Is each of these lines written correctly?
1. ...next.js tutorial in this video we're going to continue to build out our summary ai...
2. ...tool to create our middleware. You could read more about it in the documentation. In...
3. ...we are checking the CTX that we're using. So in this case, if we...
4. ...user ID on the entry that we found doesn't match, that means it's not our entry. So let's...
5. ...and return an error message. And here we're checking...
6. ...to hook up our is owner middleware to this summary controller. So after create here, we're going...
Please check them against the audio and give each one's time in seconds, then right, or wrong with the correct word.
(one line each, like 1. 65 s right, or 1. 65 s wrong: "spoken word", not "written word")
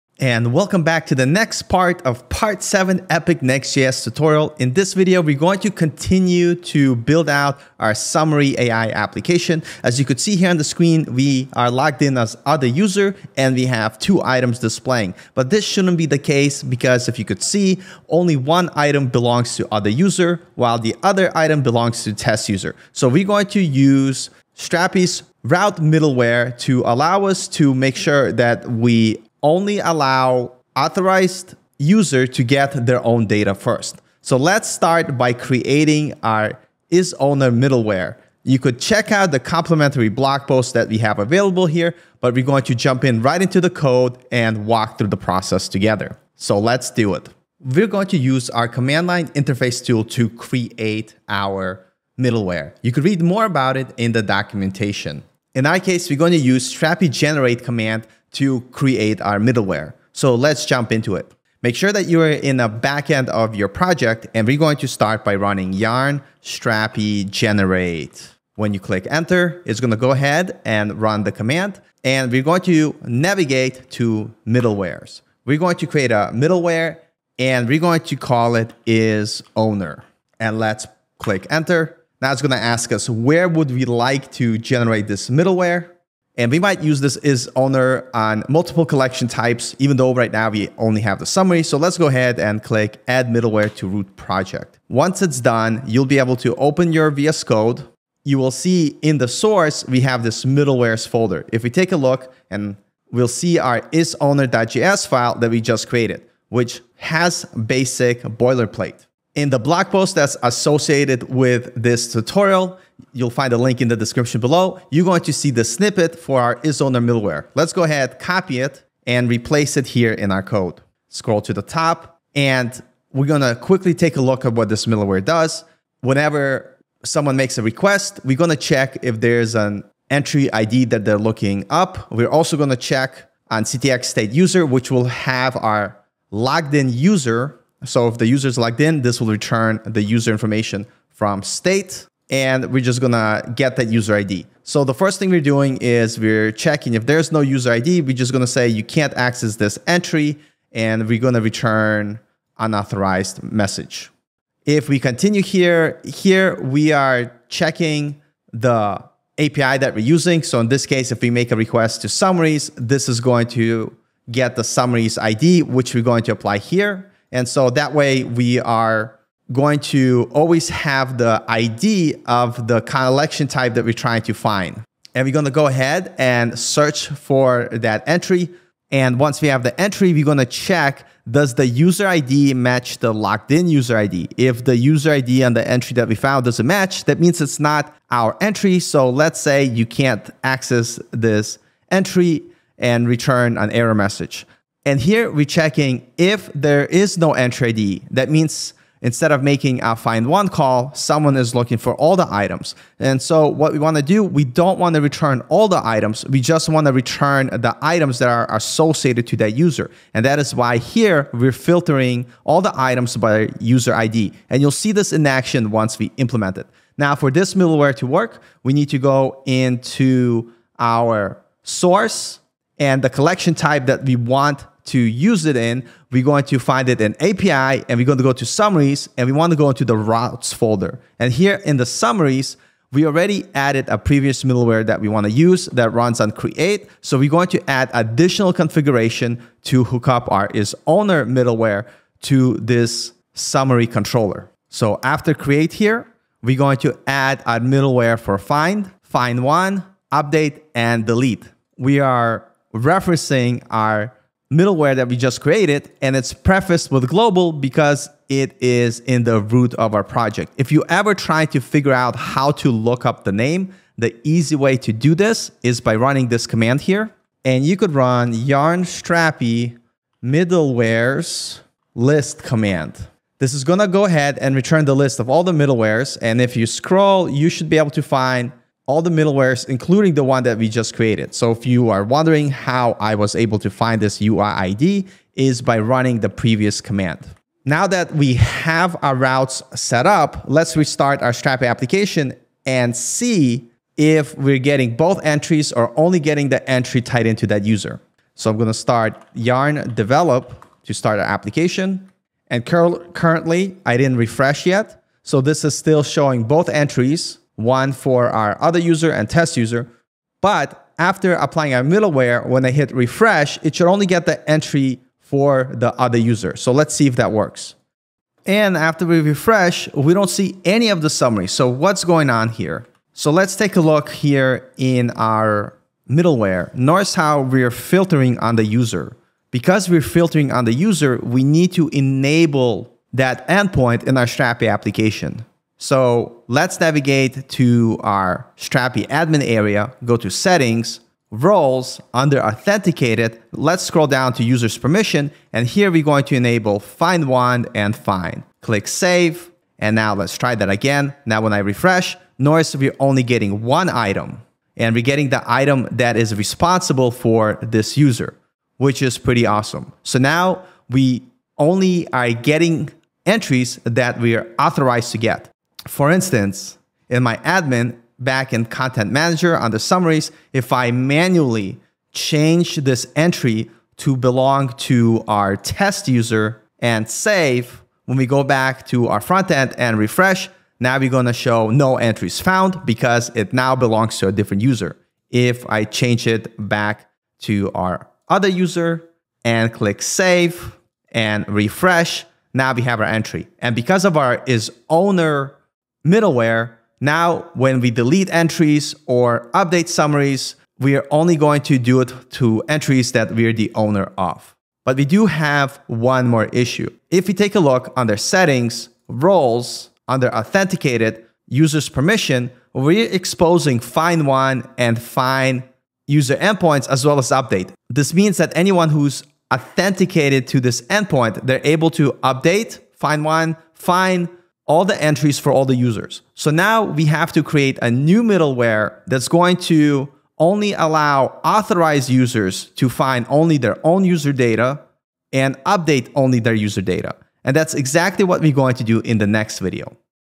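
1. 3 s right
2. 49 s right
3. 156 s wrong: "API", not "CTX"
4. 184 s right
5. 192 s right
6. 239 s right.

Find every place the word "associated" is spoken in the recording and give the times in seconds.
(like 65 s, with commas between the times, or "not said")
110 s, 208 s.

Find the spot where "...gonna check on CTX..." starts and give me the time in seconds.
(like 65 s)
132 s.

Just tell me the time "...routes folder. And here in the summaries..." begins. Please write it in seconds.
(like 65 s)
229 s.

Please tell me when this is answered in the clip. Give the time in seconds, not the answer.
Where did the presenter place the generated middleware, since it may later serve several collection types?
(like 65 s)
93 s.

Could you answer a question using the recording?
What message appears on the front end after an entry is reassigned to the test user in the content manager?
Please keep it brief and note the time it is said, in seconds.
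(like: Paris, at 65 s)
no entries found, at 381 s.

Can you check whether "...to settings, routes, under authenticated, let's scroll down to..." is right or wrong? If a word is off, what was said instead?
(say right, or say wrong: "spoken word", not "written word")
wrong: "roles", not "routes".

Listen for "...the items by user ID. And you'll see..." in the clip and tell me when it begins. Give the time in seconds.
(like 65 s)
212 s.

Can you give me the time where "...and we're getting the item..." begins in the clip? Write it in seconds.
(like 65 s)
354 s.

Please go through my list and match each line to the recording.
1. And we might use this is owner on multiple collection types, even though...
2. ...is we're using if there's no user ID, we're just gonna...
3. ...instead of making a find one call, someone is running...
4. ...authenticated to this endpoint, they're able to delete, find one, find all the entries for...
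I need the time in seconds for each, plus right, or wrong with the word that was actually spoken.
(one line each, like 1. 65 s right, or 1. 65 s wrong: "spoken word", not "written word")
1. 86 s right
2. 145 s wrong: "checking", not "using"
3. 199 s wrong: "looking", not "running"
4. 419 s wrong: "update", not "delete".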